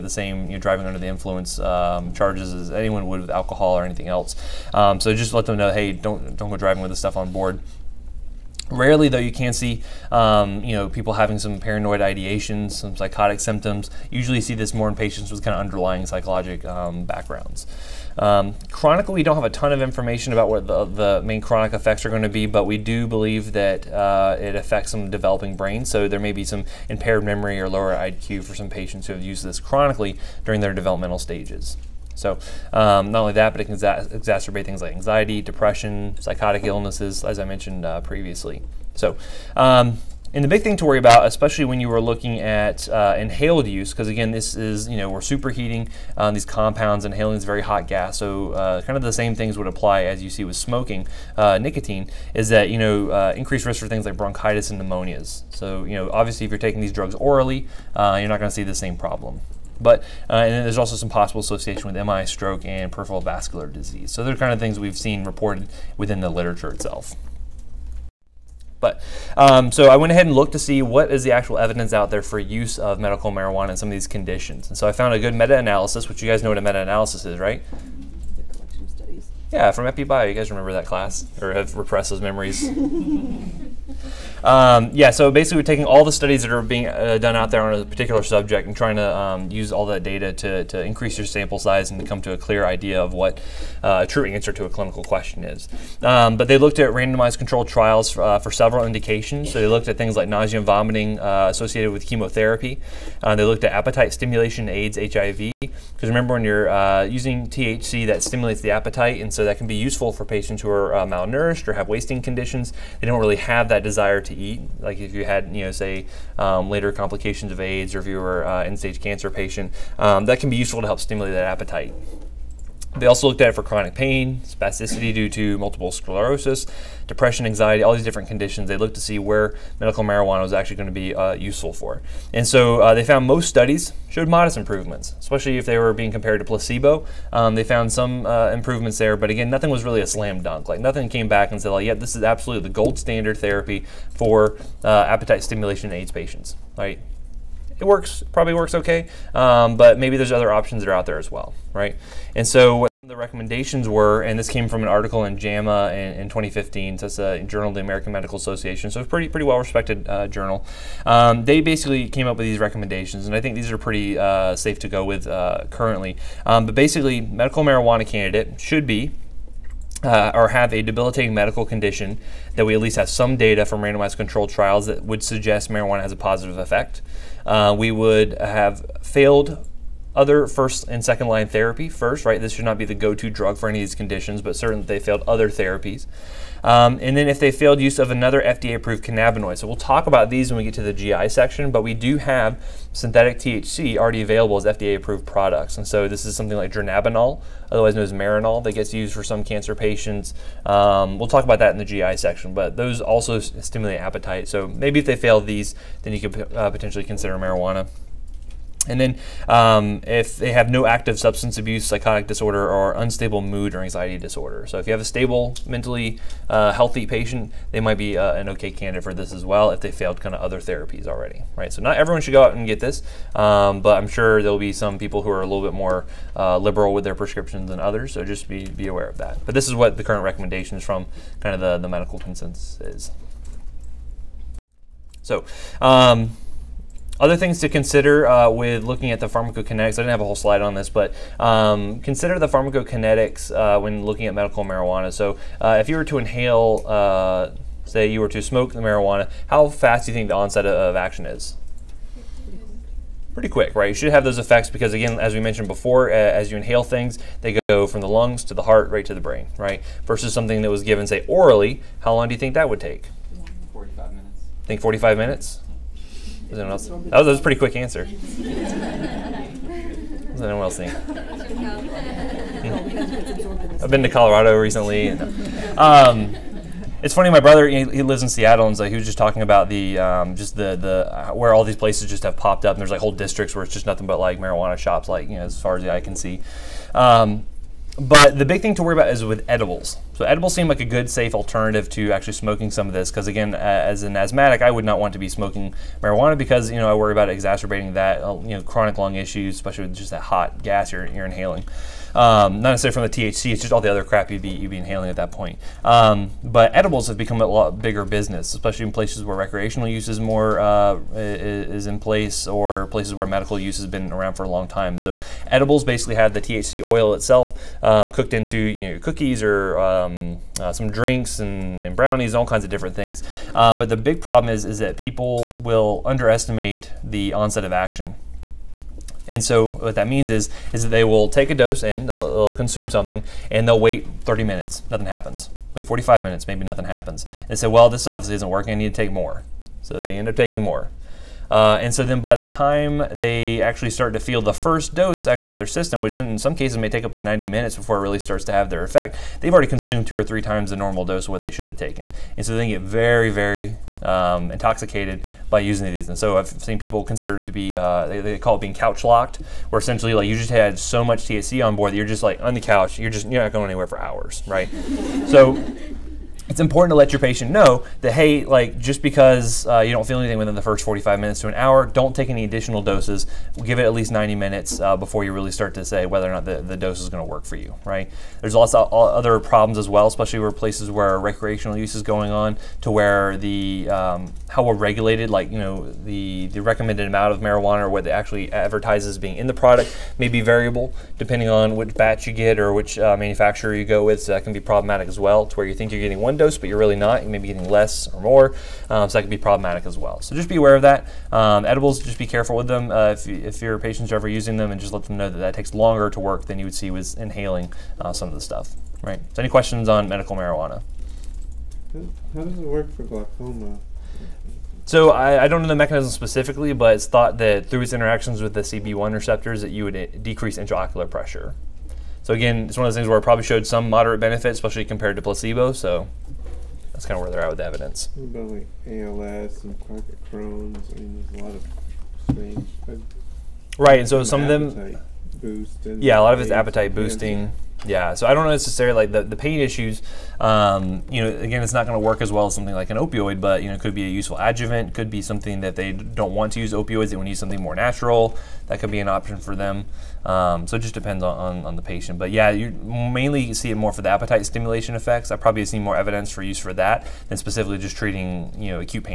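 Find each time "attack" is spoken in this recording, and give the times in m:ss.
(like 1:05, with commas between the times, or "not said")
not said.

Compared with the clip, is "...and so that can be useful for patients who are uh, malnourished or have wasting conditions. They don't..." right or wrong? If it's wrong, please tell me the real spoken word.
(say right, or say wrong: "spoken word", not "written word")
right.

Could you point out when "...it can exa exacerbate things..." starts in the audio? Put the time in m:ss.
0:33.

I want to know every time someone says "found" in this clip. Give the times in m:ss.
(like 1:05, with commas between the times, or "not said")
1:14, 2:13, 2:17.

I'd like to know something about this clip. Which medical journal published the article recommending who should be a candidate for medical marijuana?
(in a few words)
JAMA.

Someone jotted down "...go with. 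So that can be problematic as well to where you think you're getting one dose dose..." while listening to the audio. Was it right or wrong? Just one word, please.
right.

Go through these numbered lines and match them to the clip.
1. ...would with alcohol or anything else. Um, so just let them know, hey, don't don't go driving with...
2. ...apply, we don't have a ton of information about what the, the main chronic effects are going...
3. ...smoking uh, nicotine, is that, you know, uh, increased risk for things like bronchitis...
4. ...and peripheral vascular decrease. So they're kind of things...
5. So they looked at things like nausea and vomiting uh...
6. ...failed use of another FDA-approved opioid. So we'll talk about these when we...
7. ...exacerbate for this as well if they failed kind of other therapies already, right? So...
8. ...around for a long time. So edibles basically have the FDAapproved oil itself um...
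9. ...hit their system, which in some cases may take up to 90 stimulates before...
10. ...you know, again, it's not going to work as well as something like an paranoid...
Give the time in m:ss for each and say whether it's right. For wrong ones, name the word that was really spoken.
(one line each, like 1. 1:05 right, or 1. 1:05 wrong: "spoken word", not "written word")
1. 0:03 right
2. 0:18 wrong: "chronically", not "apply"
3. 0:50 right
4. 1:02 wrong: "disease", not "decrease"
5. 1:39 right
6. 3:07 wrong: "cannabinoid", not "opioid"
7. 3:38 wrong: "candidate", not "exacerbate"
8. 5:14 wrong: "THC", not "FDAapproved"
9. 5:45 wrong: "minutes", not "stimulates"
10. 7:21 wrong: "opioid", not "paranoid".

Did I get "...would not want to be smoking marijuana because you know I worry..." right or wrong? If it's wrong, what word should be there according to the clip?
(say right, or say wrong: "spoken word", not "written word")
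right.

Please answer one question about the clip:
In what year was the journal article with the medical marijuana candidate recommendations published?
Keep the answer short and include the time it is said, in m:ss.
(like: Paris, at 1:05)
2015, at 2:36.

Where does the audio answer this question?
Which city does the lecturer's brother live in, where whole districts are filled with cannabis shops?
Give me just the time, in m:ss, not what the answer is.
4:38.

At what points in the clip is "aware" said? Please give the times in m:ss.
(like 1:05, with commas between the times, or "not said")
3:48, 6:40.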